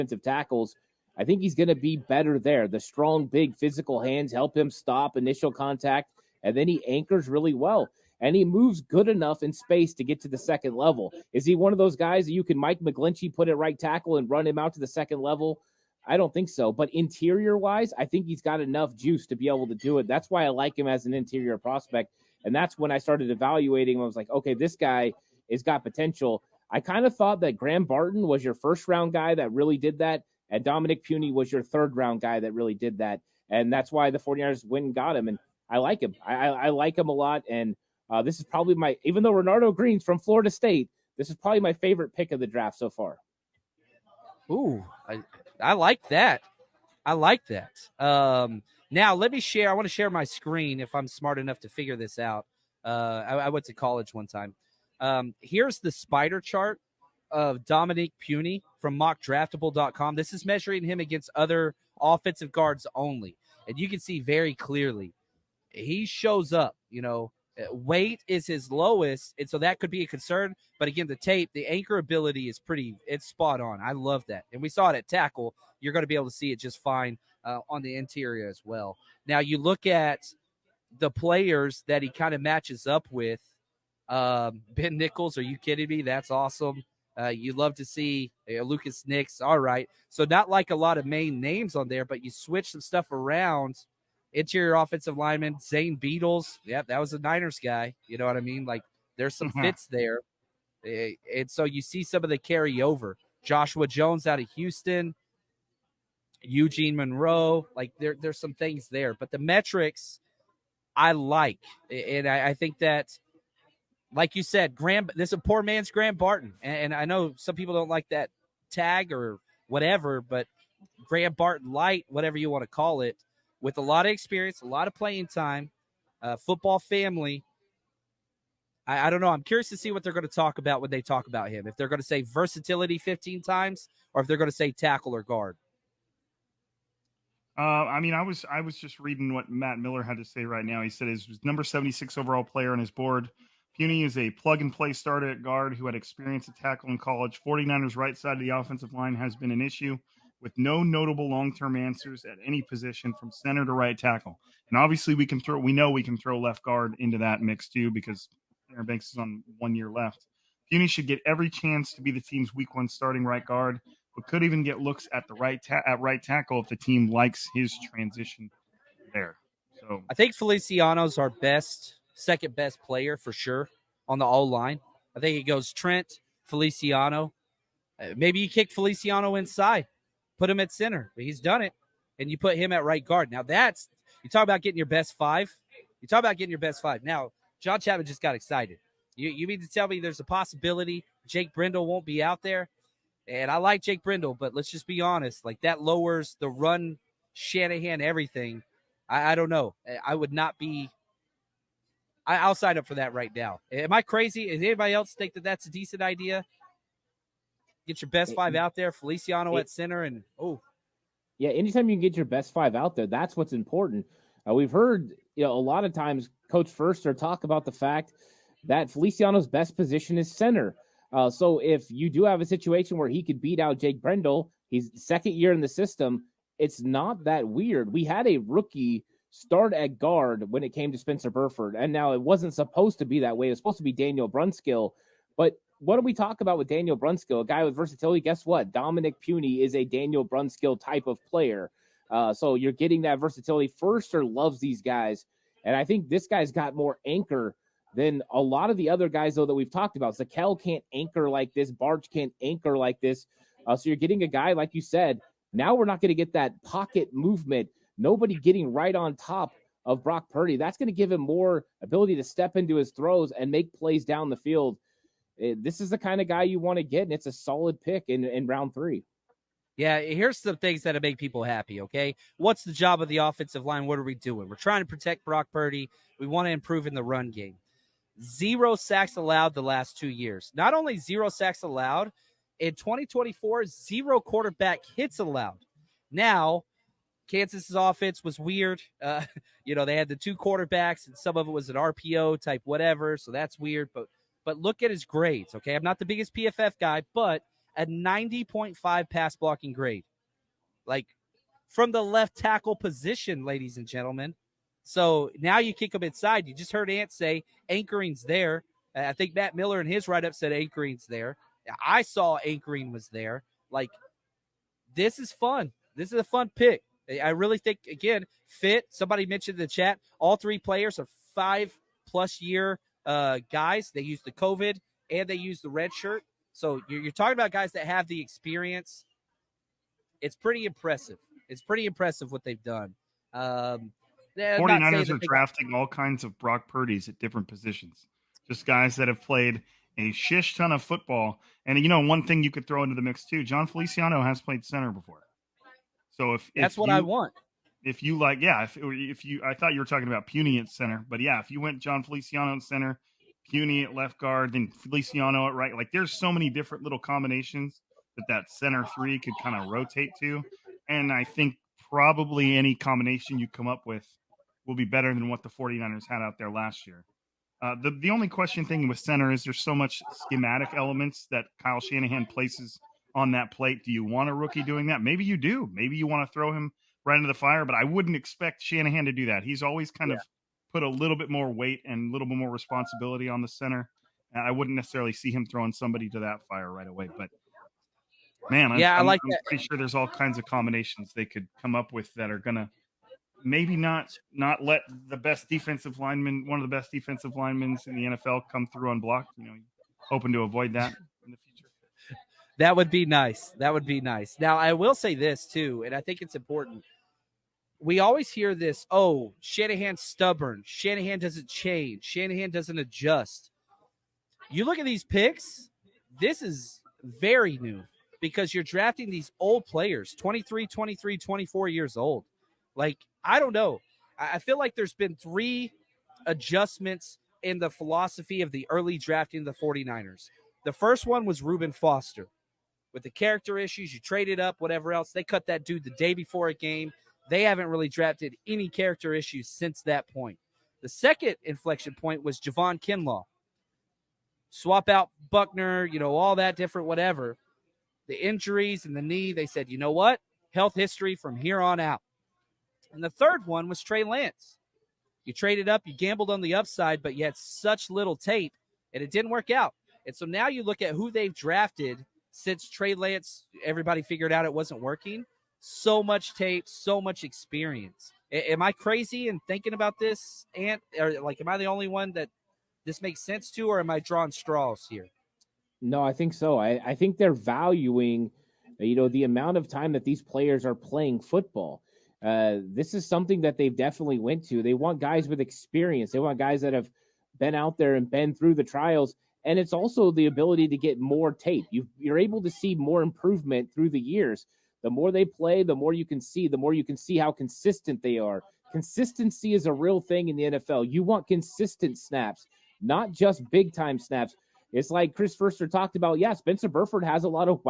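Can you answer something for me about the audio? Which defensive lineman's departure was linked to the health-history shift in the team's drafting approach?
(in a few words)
Javon Kinlaw.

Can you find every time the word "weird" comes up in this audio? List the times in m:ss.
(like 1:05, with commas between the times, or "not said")
3:47, 4:48, 4:53.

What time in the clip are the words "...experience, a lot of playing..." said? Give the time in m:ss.
2:04.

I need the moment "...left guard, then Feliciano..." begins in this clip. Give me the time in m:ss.
5:53.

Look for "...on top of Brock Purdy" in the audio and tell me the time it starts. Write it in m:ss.
4:18.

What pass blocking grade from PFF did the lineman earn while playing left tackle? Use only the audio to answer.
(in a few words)
90.5.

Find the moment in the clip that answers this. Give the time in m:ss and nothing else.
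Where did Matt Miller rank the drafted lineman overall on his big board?
2:21.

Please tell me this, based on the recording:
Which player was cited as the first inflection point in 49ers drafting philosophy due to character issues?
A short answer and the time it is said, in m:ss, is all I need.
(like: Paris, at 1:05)
Reuben Foster, at 7:11.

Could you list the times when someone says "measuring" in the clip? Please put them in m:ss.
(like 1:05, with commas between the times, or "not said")
1:00.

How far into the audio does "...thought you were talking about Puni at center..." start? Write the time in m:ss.
5:49.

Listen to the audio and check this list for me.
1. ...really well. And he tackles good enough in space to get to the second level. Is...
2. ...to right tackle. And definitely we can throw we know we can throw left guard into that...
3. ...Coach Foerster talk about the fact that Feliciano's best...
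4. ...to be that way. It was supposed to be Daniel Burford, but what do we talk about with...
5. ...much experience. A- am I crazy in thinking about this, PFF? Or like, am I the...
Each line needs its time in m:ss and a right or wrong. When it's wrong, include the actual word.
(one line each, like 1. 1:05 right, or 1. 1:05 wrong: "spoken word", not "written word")
1. 0:07 wrong: "moves", not "tackles"
2. 2:33 wrong: "obviously", not "definitely"
3. 3:36 right
4. 3:52 wrong: "Brunskill", not "Burford"
5. 7:47 wrong: "Ant", not "PFF".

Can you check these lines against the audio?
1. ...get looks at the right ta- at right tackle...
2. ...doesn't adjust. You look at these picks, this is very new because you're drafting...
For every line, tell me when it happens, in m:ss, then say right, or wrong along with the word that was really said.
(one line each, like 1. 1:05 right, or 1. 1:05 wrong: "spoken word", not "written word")
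1. 2:44 right
2. 6:52 right.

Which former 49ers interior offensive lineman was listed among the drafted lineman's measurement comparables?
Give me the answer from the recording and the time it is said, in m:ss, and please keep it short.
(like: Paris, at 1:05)
Zane Beadles, at 1:35.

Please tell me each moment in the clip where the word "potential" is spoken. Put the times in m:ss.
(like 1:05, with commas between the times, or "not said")
0:25.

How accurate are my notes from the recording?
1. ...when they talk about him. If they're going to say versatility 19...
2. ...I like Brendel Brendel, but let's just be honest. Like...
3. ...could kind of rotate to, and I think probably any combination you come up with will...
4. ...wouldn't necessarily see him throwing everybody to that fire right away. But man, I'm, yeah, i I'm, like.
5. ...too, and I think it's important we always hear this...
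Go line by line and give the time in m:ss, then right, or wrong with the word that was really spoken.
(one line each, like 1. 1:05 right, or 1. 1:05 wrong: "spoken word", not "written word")
1. 2:10 wrong: "15", not "19"
2. 3:13 wrong: "Jake", not "Brendel"
3. 5:59 right
4. 6:24 wrong: "somebody", not "everybody"
5. 6:45 right.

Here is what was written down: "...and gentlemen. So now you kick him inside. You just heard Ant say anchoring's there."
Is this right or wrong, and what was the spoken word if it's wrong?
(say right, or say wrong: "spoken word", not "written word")
right.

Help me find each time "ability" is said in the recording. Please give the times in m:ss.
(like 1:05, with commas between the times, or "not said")
1:11, 4:21, 8:10.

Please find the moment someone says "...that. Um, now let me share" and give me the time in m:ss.
0:47.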